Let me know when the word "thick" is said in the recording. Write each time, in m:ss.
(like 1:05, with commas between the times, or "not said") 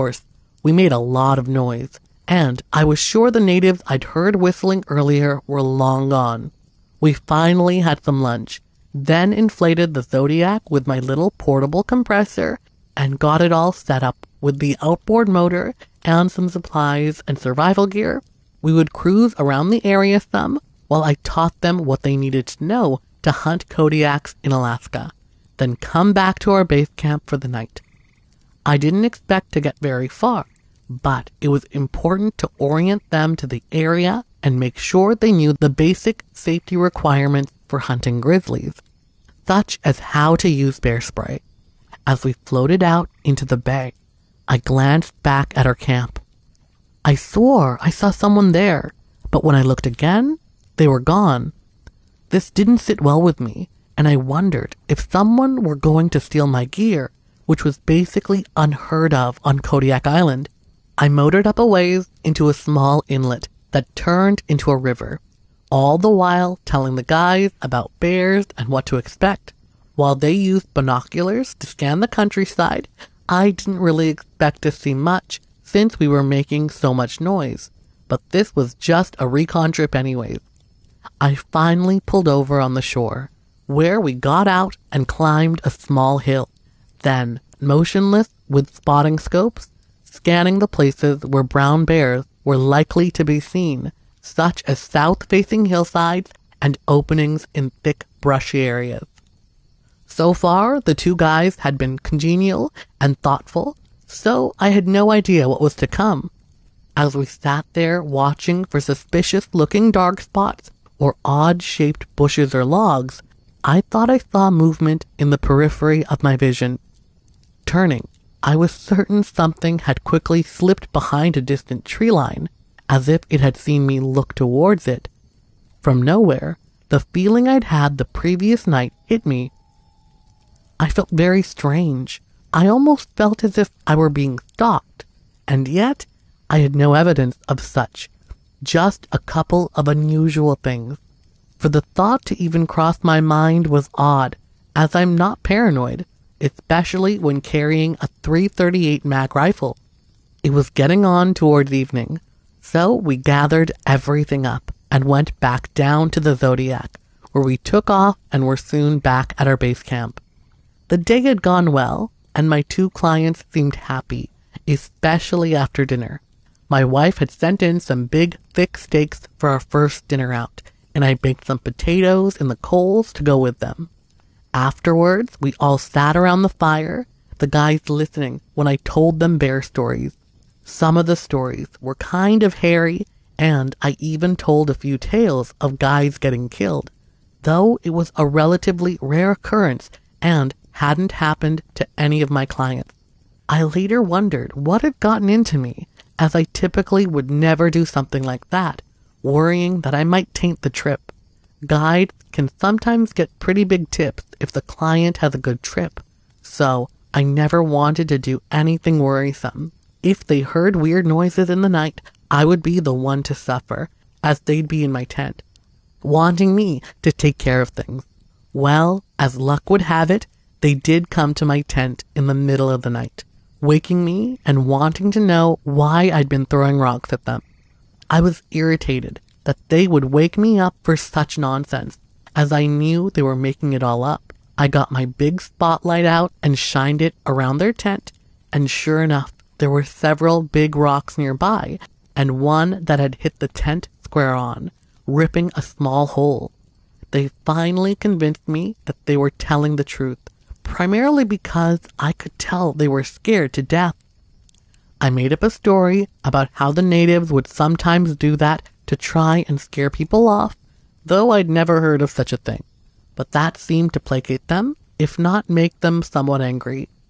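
1:37, 2:48.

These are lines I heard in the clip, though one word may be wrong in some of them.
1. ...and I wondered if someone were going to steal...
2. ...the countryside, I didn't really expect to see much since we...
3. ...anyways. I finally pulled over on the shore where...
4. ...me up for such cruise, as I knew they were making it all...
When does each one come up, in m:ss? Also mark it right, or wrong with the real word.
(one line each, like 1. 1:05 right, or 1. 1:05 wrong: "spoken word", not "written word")
1. 0:53 right
2. 1:11 right
3. 1:19 right
4. 3:50 wrong: "nonsense", not "cruise".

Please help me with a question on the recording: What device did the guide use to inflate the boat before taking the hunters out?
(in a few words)
portable compressor.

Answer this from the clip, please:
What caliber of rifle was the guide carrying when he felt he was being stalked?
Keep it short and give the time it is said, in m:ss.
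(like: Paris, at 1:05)
338 mag, at 2:28.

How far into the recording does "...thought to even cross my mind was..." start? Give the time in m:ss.
2:21.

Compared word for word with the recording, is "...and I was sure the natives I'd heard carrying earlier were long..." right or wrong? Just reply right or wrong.
wrong.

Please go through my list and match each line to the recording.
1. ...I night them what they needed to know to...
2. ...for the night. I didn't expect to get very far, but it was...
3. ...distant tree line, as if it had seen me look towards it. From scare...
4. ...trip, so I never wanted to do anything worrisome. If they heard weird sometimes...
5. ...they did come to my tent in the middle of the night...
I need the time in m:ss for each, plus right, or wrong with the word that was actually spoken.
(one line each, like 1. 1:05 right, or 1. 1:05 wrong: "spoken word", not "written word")
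1. 0:21 wrong: "taught", not "night"
2. 0:27 right
3. 2:01 wrong: "nowhere", not "scare"
4. 3:25 wrong: "noises", not "sometimes"
5. 3:40 right.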